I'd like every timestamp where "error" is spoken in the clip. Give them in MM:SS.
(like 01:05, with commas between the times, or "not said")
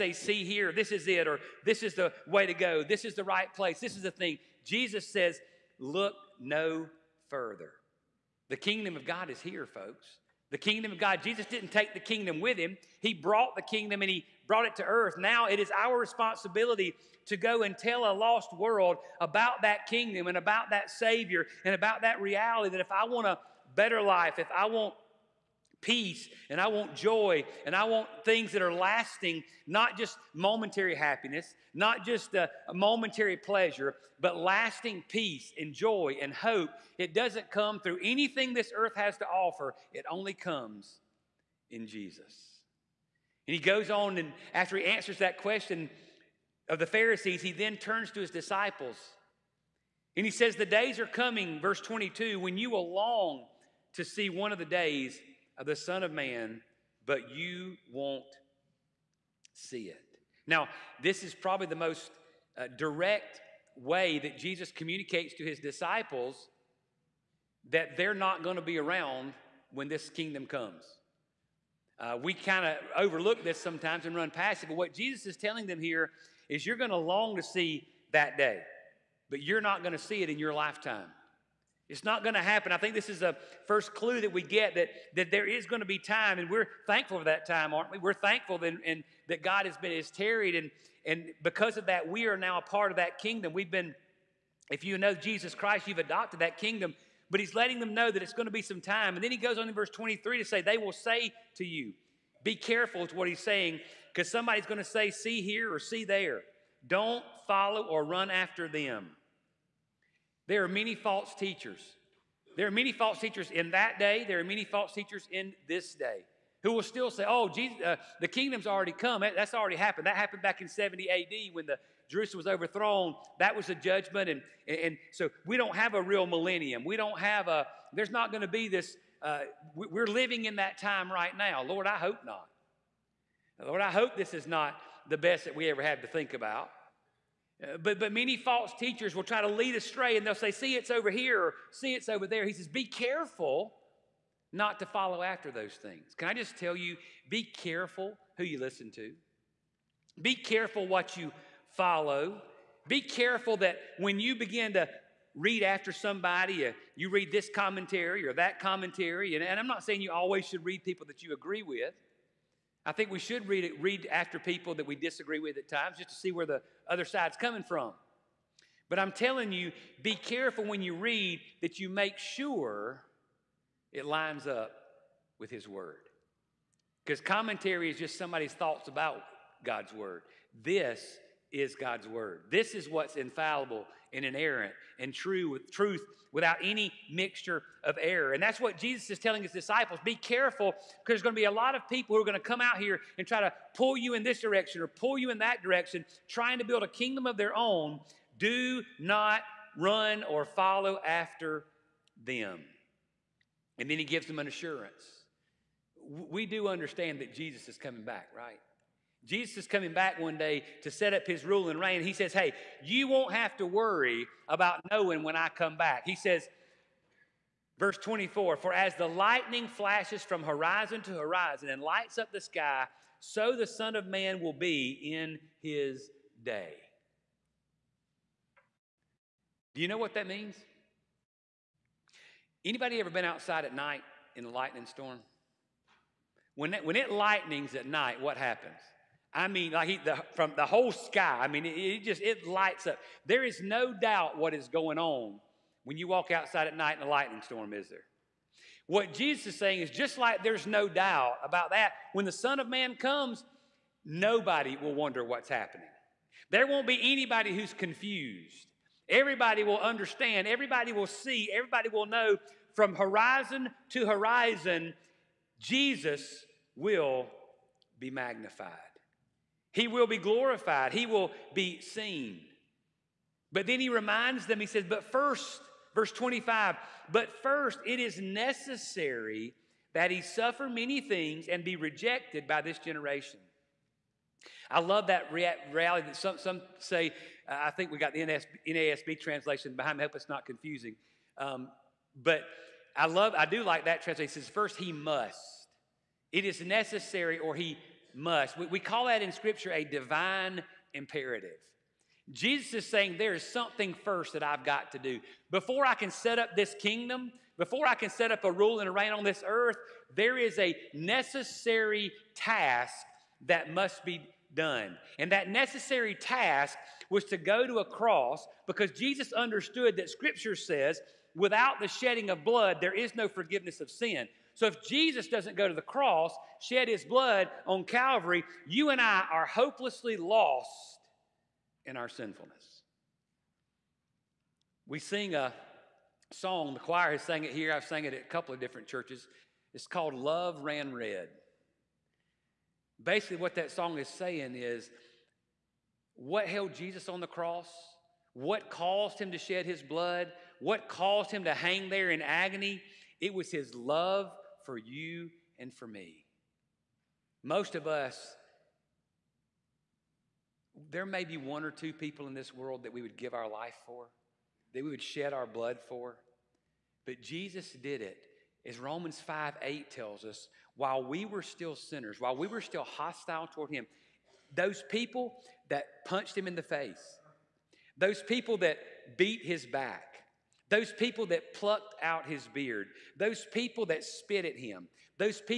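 03:08.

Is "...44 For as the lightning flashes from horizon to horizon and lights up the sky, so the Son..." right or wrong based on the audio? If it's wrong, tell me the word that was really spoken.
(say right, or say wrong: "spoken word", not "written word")
wrong: "24", not "44".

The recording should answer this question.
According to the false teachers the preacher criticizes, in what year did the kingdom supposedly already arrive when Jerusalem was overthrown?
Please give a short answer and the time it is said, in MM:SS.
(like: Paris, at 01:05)
70 A.D., at 02:00.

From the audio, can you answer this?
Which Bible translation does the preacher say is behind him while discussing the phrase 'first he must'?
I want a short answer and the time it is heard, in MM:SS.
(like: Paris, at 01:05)
NASB, at 04:48.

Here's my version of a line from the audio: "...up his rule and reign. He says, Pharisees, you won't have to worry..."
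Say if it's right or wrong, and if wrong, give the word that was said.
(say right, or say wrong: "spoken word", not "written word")
wrong: "Hey", not "Pharisees".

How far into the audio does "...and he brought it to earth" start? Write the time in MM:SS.
00:14.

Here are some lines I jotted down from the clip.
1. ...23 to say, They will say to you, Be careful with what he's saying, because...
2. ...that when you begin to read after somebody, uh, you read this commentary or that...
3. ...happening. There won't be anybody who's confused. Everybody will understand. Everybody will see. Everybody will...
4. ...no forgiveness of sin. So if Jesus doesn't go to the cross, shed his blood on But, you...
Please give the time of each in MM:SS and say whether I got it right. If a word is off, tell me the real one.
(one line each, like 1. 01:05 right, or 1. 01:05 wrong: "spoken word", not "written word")
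1. 01:39 right
2. 02:33 right
3. 04:15 right
4. 05:23 wrong: "Calvary", not "But".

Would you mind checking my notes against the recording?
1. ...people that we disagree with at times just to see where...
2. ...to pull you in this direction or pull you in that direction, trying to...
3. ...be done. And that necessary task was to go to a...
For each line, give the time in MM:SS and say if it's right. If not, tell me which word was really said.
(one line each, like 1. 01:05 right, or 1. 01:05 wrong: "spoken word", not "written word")
1. 02:44 right
2. 03:13 right
3. 05:14 right.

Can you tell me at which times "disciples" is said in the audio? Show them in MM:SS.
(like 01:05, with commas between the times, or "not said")
00:48, 01:05, 03:09.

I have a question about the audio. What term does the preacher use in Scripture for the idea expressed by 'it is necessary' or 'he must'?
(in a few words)
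Divine imperative.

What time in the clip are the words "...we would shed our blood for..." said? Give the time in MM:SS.
06:04.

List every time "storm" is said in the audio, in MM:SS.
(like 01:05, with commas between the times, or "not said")
03:54, 04:07.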